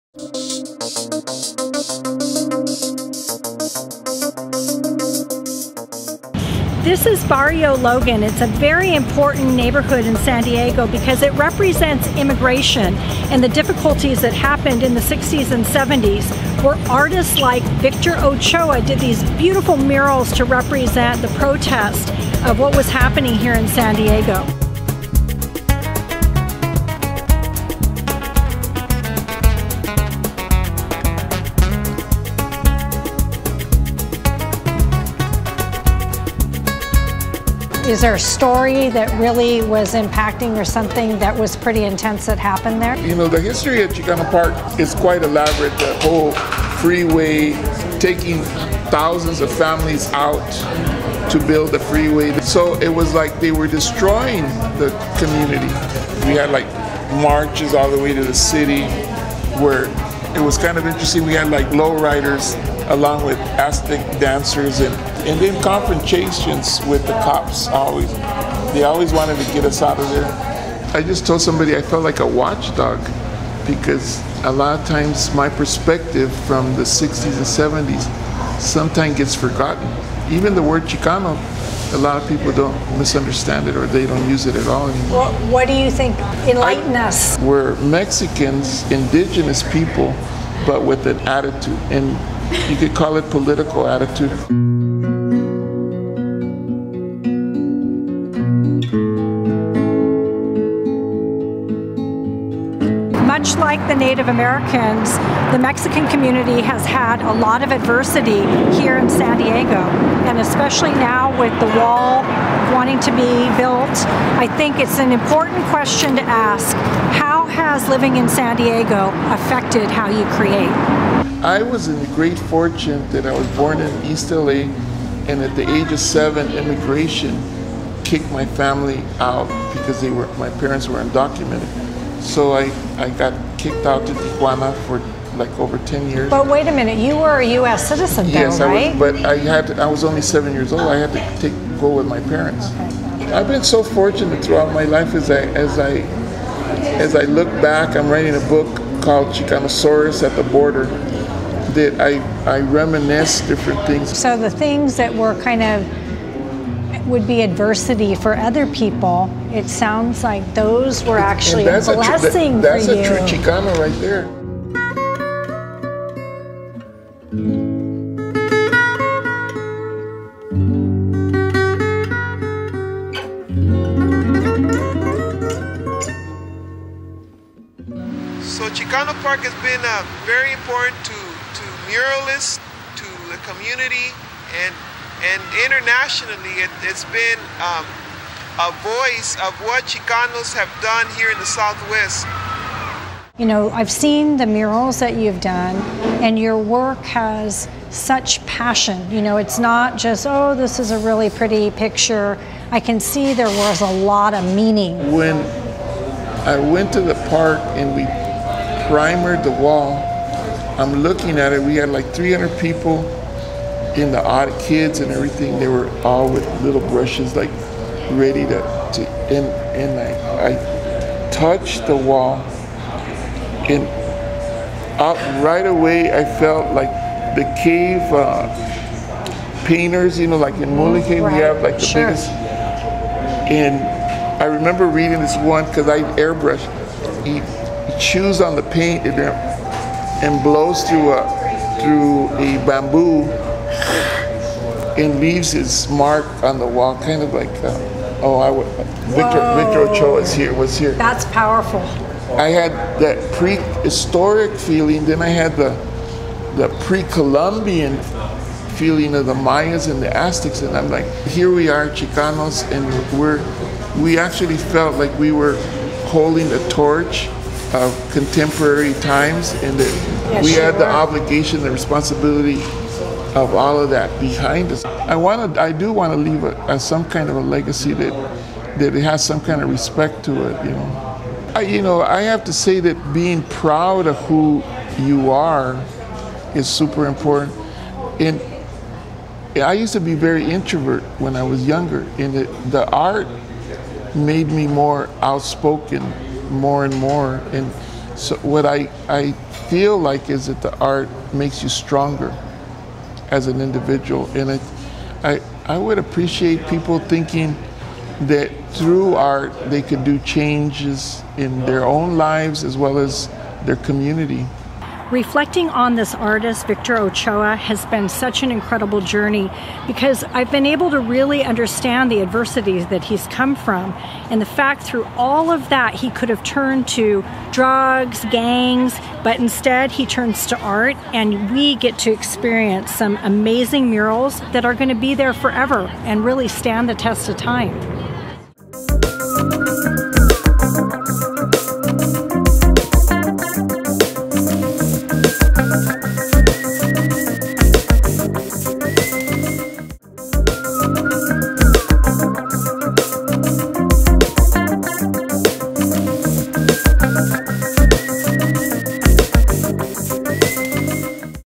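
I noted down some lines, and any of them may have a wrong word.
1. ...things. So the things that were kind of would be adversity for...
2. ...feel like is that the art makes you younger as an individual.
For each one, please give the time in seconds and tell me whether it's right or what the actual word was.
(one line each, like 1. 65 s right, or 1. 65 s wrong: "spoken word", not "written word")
1. 153 s right
2. 299 s wrong: "stronger", not "younger".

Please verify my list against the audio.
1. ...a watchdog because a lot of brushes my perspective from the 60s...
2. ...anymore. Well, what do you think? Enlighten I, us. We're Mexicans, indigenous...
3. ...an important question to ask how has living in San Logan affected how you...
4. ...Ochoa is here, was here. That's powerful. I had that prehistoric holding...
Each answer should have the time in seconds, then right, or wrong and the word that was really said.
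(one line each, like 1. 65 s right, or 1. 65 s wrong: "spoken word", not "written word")
1. 72 s wrong: "times", not "brushes"
2. 84 s right
3. 114 s wrong: "Diego", not "Logan"
4. 249 s wrong: "feeling", not "holding".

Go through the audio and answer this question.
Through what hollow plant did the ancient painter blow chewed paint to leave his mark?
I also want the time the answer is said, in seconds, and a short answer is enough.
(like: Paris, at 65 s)
Bamboo, at 242 s.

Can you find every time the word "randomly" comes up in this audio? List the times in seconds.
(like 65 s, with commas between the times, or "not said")
not said.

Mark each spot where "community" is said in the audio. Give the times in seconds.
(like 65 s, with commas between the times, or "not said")
55 s, 106 s, 183 s, 313 s.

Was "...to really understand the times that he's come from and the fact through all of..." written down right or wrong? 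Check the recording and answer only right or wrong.
wrong.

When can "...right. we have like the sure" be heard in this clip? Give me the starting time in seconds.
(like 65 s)
231 s.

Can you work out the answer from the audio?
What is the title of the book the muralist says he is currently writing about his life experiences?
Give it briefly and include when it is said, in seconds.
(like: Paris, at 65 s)
Chicanosaurus at the Border, at 149 s.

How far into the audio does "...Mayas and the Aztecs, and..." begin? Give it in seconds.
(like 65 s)
259 s.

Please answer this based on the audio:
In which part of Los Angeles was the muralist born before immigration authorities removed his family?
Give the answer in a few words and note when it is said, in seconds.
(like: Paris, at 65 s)
East LA, at 124 s.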